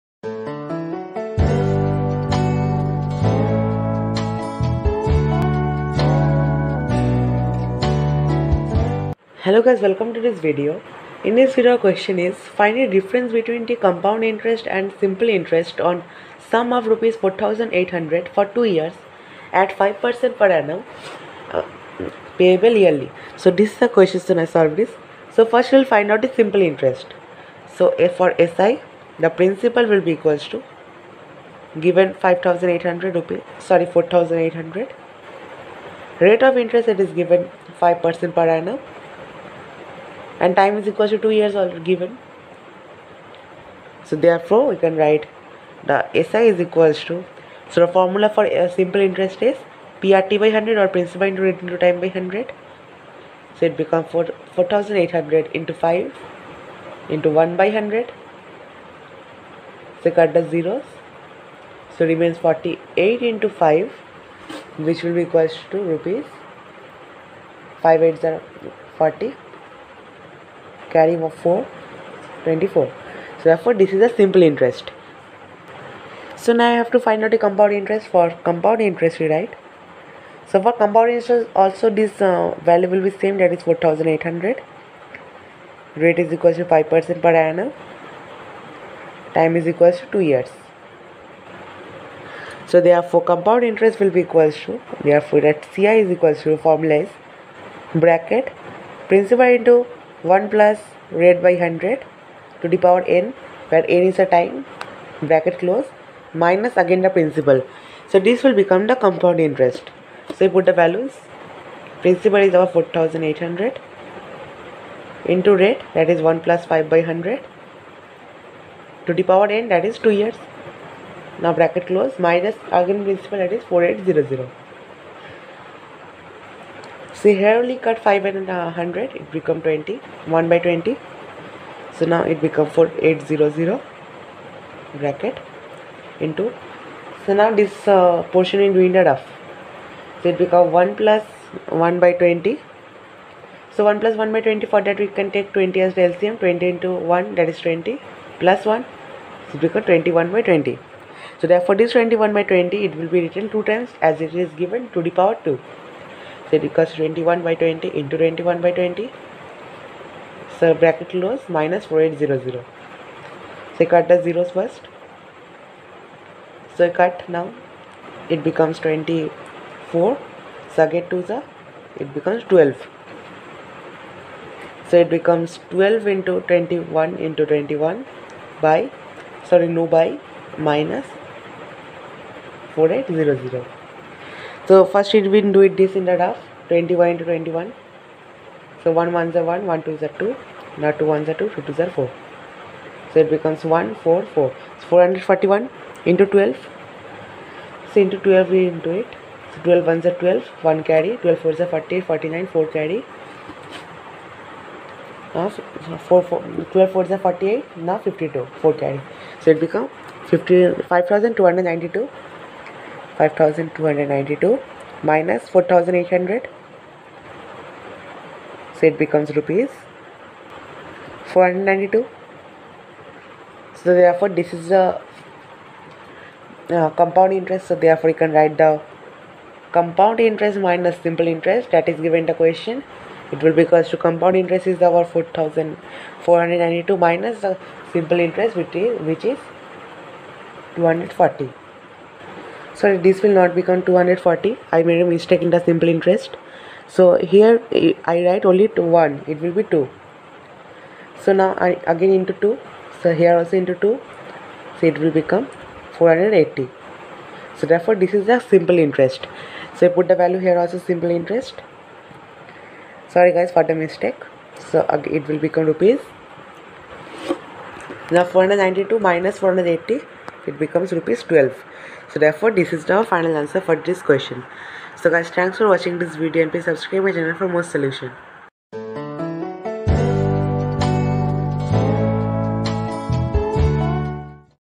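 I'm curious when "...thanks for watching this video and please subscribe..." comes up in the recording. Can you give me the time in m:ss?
4:35.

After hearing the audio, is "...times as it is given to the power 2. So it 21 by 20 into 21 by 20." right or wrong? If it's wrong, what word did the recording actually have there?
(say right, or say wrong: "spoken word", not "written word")
right.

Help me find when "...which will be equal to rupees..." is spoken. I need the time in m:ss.
1:04.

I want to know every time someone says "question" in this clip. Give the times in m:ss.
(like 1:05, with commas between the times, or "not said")
0:11, 0:23, 3:52, 4:34.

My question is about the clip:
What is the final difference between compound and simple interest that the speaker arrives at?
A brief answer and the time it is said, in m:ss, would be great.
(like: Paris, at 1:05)
Rs 12, at 4:30.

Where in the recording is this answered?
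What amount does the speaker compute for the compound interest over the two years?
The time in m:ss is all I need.
3:39.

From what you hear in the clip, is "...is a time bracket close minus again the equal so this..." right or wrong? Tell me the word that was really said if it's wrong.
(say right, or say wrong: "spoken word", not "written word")
wrong: "principal", not "equal".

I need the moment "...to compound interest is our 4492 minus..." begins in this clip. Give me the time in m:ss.
3:53.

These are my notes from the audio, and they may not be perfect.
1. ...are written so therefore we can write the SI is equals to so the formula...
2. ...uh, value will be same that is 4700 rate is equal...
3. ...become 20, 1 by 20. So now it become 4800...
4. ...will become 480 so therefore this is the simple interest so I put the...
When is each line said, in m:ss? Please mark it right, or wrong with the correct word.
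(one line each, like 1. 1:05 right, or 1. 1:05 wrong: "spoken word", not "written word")
1. 0:41 wrong: "given", not "written"
2. 1:22 wrong: "4800", not "4700"
3. 2:09 right
4. 4:15 right.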